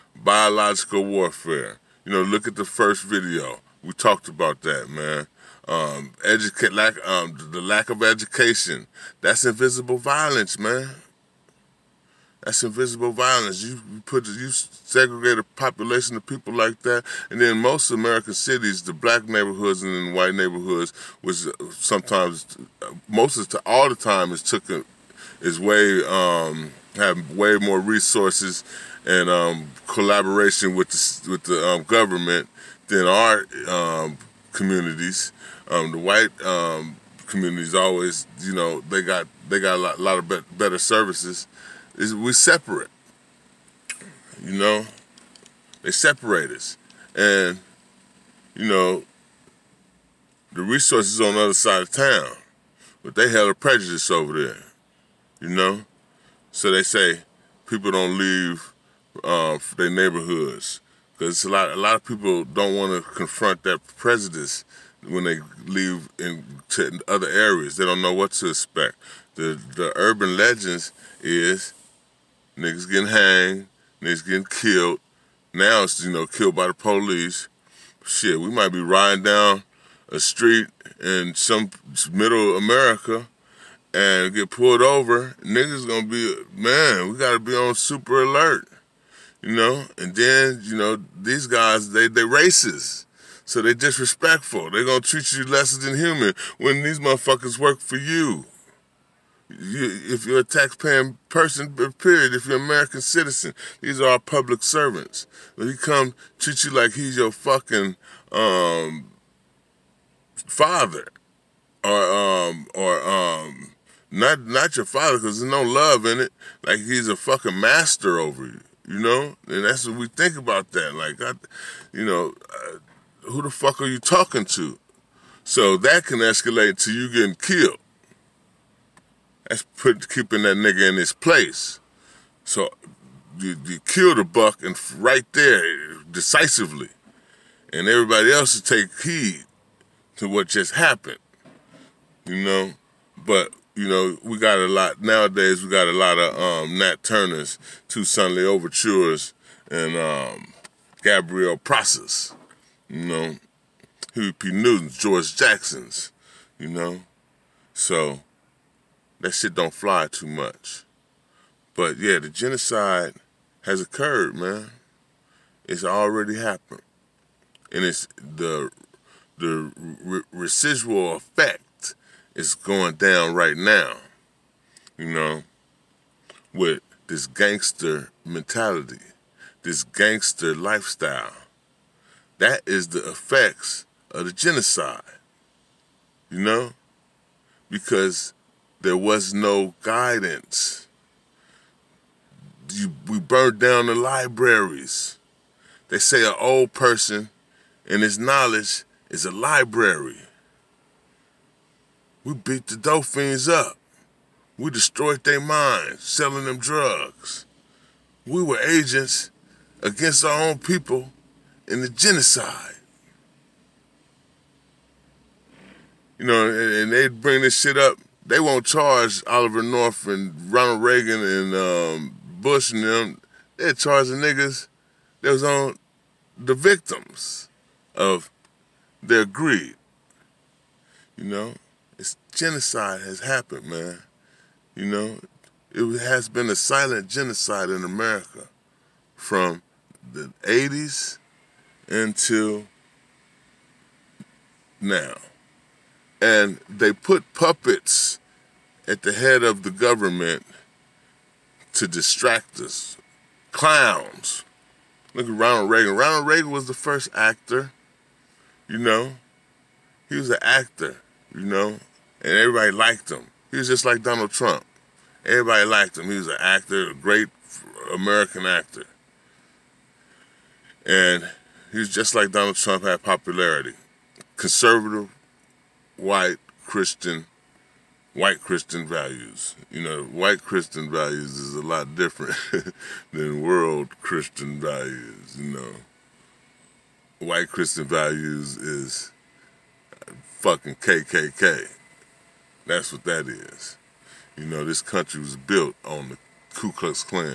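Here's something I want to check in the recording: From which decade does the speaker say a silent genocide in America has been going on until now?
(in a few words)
the 80s.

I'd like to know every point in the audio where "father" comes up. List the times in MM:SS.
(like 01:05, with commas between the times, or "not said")
01:50, 01:54.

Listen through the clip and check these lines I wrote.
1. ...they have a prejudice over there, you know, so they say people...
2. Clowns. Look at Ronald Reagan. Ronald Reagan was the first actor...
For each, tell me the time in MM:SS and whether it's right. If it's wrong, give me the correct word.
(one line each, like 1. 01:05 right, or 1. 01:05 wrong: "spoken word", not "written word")
1. 00:53 right
2. 04:13 right.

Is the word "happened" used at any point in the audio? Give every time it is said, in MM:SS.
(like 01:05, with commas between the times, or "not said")
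02:20, 02:46, 03:53.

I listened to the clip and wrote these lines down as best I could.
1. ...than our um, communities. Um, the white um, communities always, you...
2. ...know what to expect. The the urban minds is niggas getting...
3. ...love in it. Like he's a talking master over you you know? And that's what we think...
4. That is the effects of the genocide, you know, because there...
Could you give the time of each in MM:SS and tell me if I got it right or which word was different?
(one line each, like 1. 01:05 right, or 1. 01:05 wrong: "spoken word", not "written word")
1. 00:32 right
2. 01:08 wrong: "legends", not "minds"
3. 01:55 wrong: "fucking", not "talking"
4. 03:02 right.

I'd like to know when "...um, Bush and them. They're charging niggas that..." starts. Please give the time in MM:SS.
03:41.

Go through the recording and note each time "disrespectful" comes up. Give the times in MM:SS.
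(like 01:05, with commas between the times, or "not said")
01:33.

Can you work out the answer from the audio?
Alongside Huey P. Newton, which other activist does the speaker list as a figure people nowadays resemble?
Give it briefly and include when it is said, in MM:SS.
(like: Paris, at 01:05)
George Jackson, at 02:34.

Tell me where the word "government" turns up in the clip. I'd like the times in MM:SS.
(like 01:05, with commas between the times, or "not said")
00:31, 04:09.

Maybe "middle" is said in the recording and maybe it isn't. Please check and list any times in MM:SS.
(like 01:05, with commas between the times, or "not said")
01:22.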